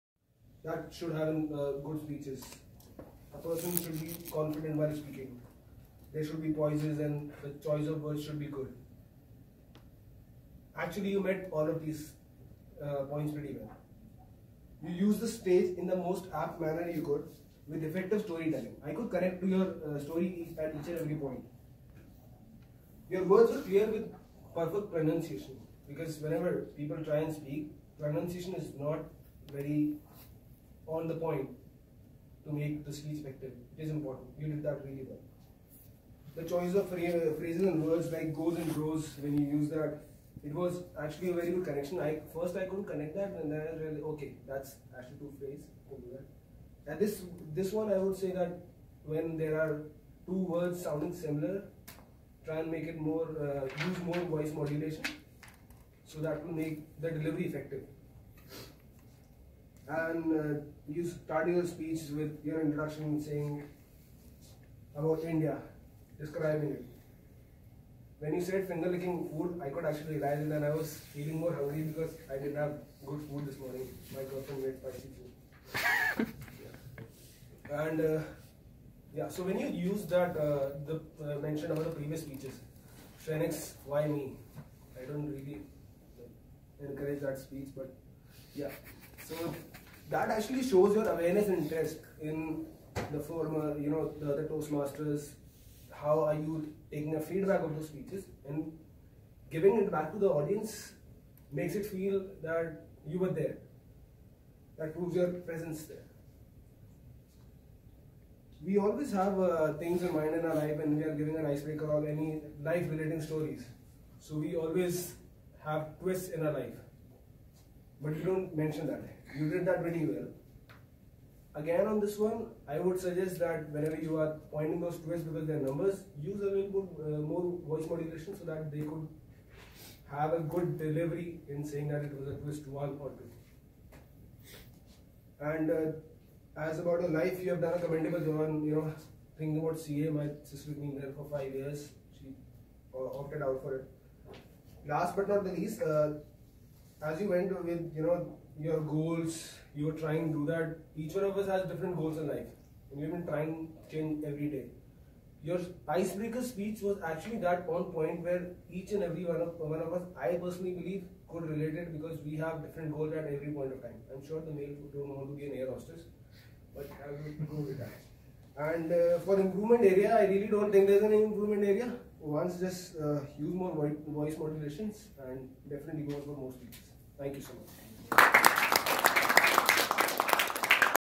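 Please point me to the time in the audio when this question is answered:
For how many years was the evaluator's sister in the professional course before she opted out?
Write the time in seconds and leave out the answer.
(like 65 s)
141 s.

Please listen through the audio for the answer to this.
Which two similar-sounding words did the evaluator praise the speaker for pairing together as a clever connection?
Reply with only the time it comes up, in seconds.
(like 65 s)
38 s.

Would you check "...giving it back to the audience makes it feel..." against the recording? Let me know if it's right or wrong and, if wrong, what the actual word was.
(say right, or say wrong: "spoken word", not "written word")
right.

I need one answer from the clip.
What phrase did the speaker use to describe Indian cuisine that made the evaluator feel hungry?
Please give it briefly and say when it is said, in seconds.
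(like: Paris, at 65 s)
finger licking food, at 68 s.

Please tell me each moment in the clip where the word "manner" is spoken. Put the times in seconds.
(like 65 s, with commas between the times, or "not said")
16 s.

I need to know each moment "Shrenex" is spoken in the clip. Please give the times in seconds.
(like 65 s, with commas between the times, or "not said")
83 s.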